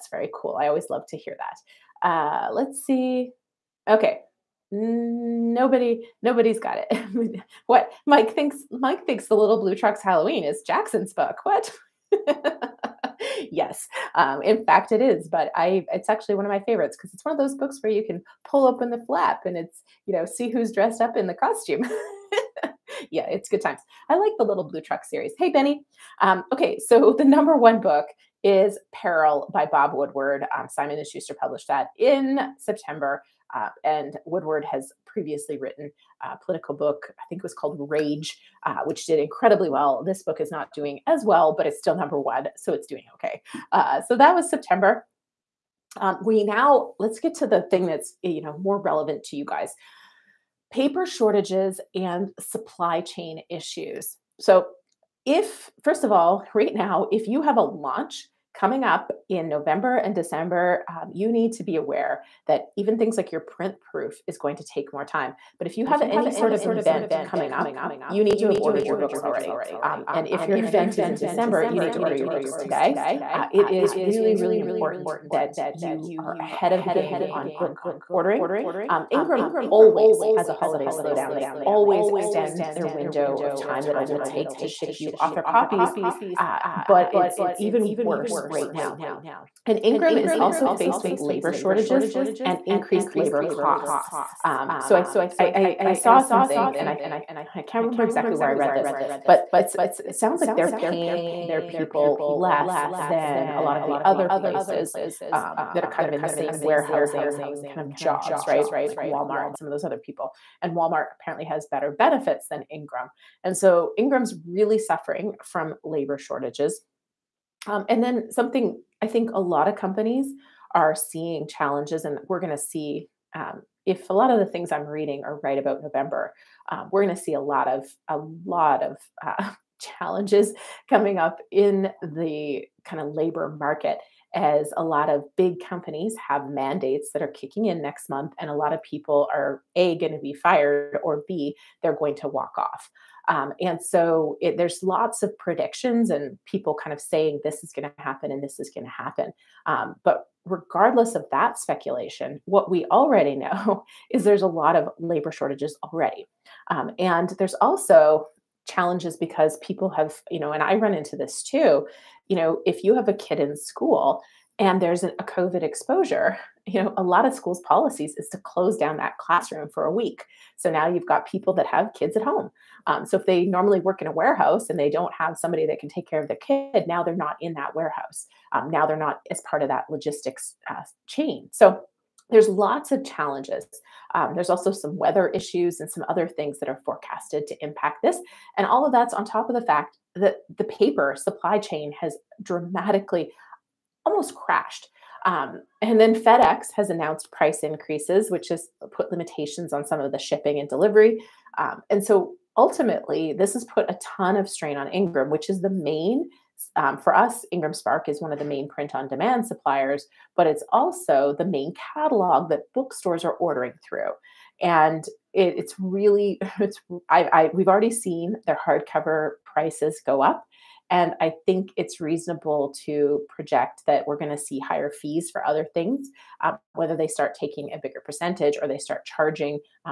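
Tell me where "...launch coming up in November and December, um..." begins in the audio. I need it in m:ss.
0:57.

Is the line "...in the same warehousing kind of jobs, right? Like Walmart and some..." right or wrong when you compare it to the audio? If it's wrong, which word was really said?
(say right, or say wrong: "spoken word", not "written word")
right.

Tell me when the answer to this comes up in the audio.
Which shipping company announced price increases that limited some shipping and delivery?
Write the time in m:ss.
3:16.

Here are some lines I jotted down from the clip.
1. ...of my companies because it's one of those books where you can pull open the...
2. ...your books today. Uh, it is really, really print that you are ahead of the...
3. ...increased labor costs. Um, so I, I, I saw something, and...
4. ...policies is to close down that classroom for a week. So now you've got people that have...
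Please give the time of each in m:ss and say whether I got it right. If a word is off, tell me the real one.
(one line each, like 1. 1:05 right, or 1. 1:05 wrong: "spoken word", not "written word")
1. 0:16 wrong: "favorites", not "companies"
2. 1:12 wrong: "important", not "print"
3. 1:32 right
4. 2:47 right.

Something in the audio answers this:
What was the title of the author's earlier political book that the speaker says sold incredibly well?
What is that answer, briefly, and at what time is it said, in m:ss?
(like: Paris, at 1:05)
Rage, at 0:37.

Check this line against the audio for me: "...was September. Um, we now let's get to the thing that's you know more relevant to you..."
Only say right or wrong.
right.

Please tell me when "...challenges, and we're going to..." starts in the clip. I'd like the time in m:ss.
2:01.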